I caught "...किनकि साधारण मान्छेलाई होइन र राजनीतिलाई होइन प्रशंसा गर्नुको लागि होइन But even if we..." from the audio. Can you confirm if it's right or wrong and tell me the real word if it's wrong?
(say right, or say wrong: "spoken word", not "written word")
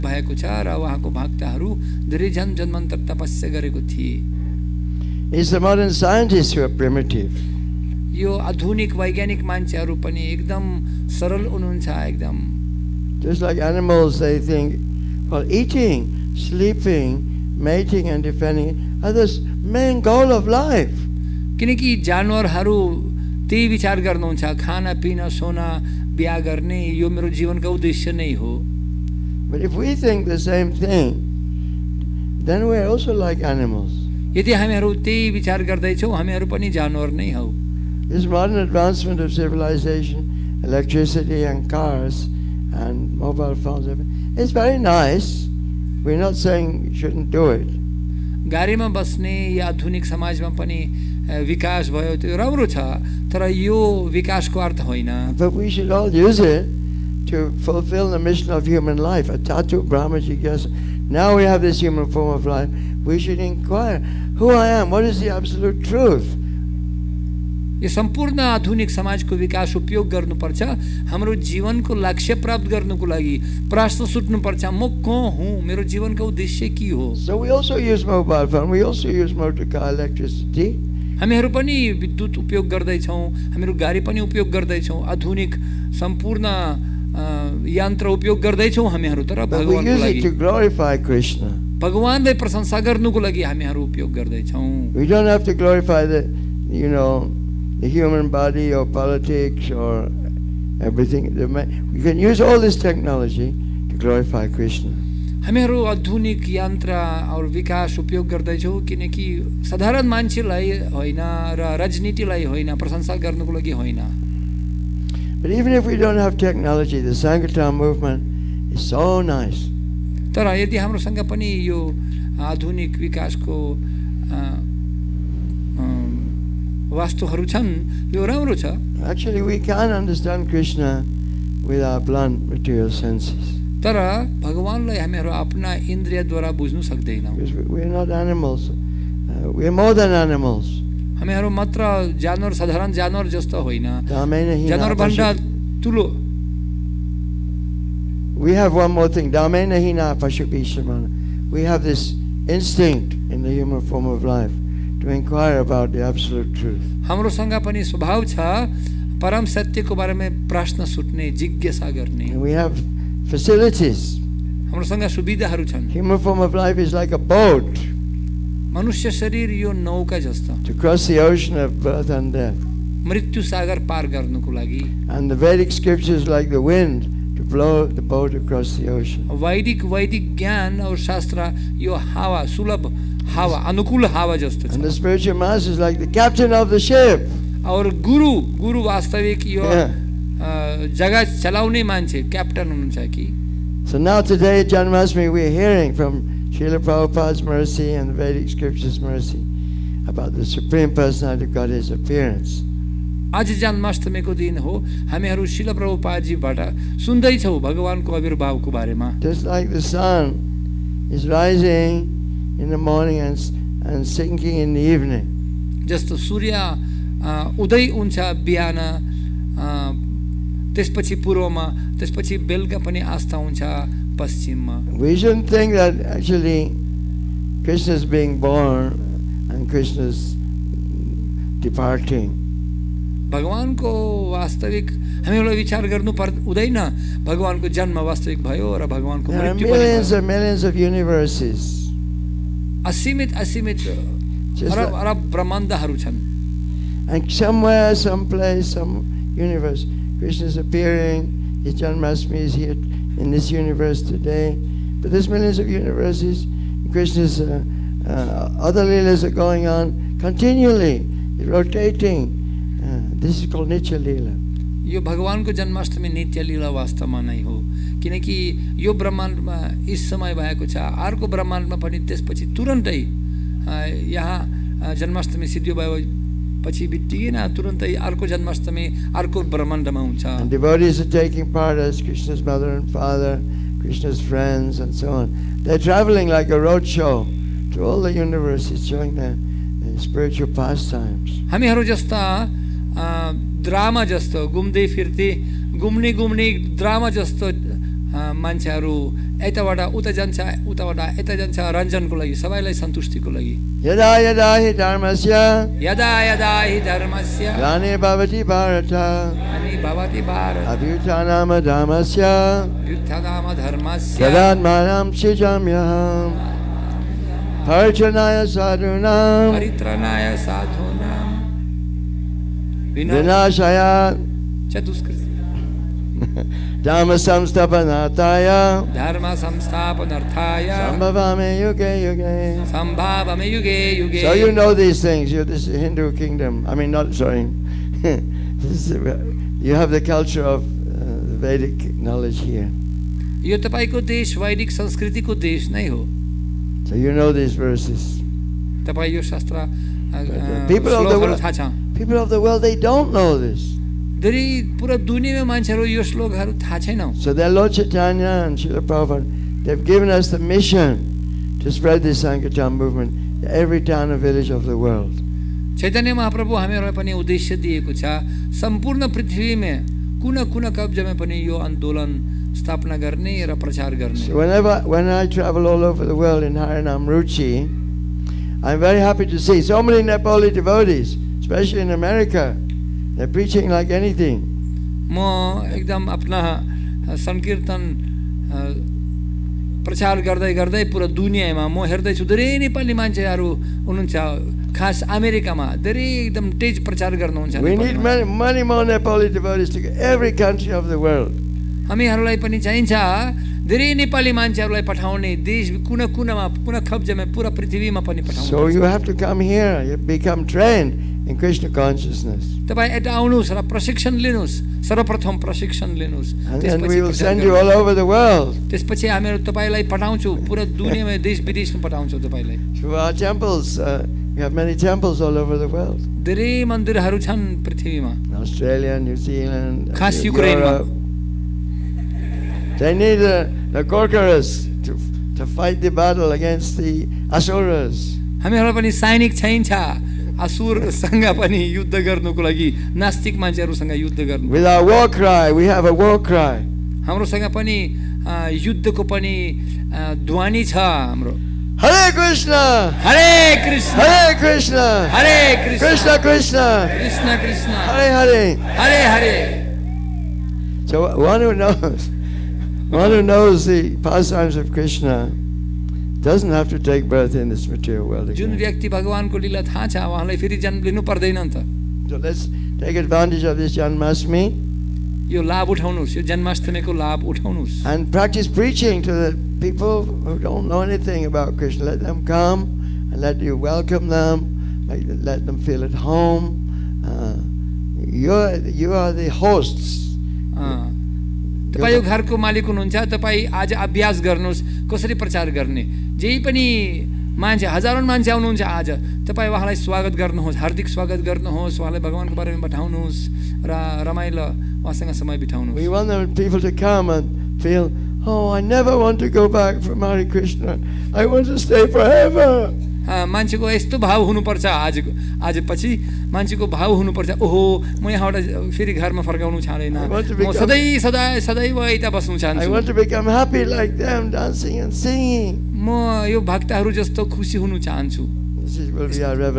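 right.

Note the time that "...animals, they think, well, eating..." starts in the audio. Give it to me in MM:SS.
00:13.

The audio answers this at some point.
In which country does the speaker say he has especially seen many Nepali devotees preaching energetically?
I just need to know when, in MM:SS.
06:21.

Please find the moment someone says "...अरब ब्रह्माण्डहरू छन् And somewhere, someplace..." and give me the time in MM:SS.
04:05.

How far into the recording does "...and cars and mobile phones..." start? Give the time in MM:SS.
00:41.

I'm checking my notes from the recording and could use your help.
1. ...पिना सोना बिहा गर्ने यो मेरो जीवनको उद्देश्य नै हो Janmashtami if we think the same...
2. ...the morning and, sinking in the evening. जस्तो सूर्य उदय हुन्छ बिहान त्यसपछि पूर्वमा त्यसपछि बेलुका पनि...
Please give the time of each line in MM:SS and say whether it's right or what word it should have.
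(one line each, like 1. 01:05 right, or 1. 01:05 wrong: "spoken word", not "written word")
1. 00:25 wrong: "But", not "Janmashtami"
2. 03:32 right.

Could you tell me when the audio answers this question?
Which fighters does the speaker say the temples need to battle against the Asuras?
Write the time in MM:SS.
07:13.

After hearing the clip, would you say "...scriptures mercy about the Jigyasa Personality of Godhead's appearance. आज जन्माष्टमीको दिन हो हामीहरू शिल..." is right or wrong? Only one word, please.
wrong.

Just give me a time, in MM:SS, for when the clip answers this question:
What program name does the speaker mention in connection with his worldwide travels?
06:16.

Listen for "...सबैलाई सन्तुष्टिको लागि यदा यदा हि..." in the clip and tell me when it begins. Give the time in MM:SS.
05:02.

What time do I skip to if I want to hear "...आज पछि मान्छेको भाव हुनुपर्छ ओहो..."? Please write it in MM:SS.
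08:35.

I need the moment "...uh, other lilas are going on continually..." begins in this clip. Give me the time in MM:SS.
04:18.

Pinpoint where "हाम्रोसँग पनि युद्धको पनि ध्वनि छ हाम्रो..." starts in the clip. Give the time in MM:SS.
07:27.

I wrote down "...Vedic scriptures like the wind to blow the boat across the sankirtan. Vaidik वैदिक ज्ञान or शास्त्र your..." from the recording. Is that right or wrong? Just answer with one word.
wrong.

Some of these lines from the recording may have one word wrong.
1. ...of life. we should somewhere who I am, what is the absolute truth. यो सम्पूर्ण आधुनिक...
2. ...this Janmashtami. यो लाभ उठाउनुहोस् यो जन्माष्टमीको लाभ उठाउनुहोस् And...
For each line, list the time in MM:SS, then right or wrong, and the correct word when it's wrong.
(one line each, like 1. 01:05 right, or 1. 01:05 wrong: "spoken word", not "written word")
1. 01:02 wrong: "inquire", not "somewhere"
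2. 07:53 right.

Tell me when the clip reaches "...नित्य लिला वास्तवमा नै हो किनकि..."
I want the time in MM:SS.
04:26.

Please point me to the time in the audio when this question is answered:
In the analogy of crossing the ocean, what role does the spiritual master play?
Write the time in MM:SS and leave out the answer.
03:05.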